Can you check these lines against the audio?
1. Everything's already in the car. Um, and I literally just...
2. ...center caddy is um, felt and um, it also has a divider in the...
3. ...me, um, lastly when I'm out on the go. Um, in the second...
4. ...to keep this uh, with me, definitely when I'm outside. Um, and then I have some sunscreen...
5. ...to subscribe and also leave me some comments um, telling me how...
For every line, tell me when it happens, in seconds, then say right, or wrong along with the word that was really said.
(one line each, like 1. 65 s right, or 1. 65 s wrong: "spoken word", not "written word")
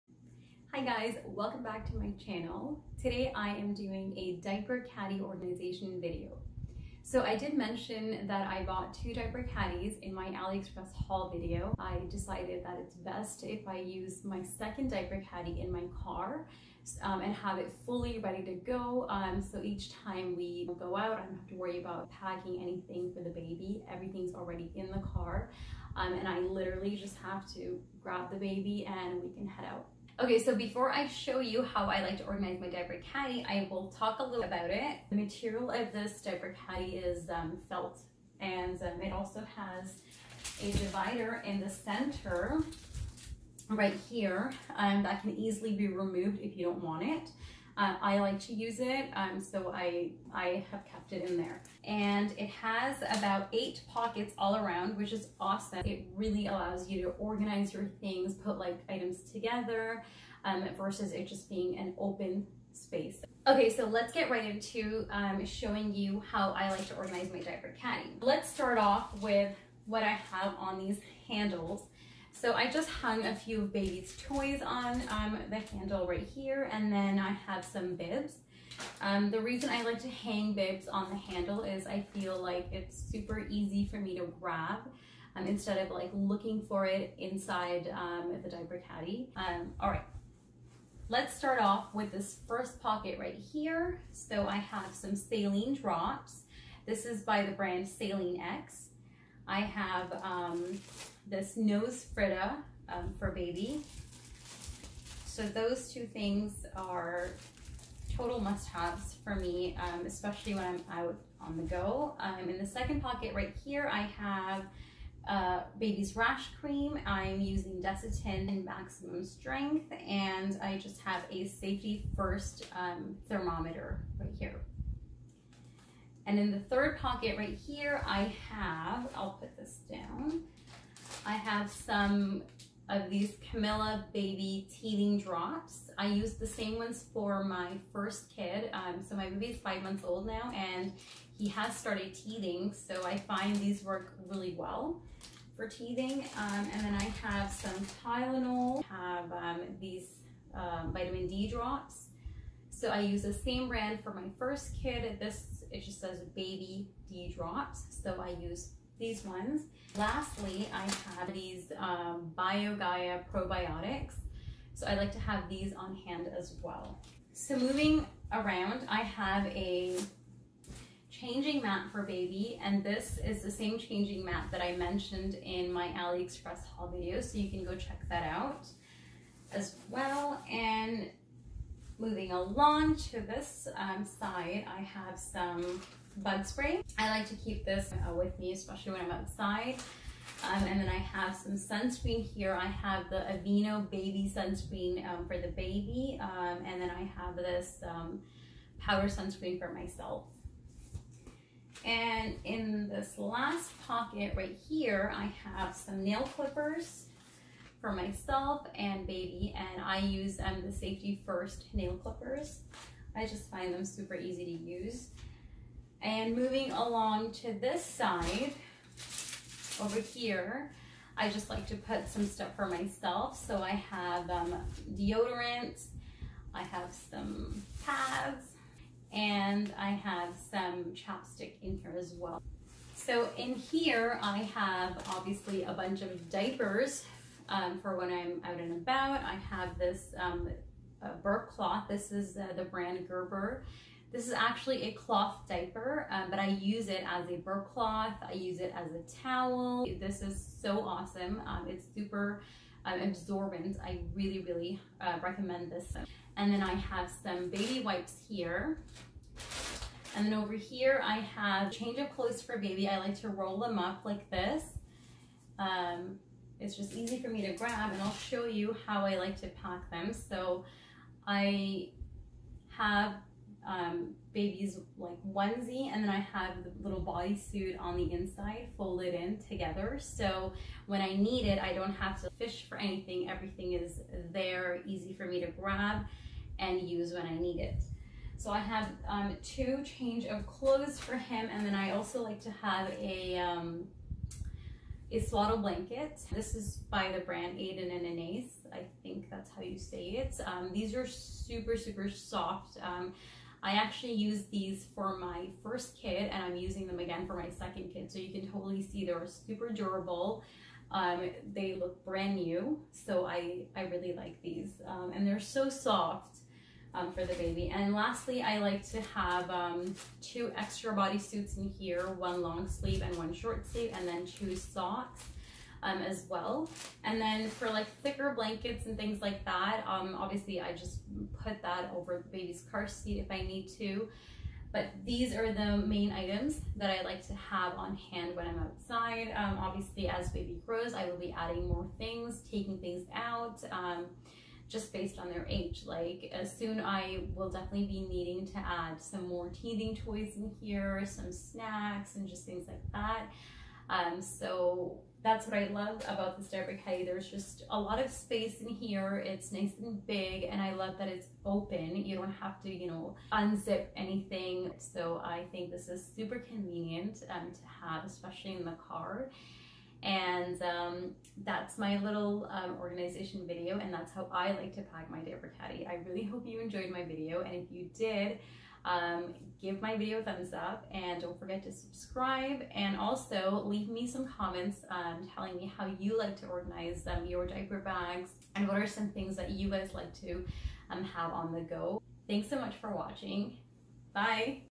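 1. 23 s right
2. 36 s wrong: "diaper", not "center"
3. 109 s wrong: "especially", not "lastly"
4. 187 s wrong: "especially", not "definitely"
5. 381 s right.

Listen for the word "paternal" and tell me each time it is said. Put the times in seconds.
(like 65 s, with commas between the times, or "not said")
not said.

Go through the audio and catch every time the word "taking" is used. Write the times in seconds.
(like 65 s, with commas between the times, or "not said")
342 s.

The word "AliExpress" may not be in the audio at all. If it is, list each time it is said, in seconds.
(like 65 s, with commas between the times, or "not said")
10 s, 175 s.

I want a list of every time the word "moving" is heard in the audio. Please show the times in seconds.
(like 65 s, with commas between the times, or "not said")
167 s, 182 s, 216 s.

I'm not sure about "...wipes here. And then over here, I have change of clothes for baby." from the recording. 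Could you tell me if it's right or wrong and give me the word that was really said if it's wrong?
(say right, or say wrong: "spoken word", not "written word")
right.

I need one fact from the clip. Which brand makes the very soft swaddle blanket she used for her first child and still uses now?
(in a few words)
Aden and Anais.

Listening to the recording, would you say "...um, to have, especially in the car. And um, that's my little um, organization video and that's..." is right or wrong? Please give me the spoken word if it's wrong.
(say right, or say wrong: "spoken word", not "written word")
right.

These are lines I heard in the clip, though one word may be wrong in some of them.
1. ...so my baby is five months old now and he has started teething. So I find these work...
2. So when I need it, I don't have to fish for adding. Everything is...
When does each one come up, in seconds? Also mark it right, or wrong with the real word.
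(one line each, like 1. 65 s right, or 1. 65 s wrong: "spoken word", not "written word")
1. 139 s right
2. 279 s wrong: "anything", not "adding".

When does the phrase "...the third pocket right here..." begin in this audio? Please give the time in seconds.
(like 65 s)
126 s.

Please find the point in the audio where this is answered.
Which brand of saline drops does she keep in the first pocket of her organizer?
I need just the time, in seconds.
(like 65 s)
97 s.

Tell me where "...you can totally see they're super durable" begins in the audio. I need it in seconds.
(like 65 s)
308 s.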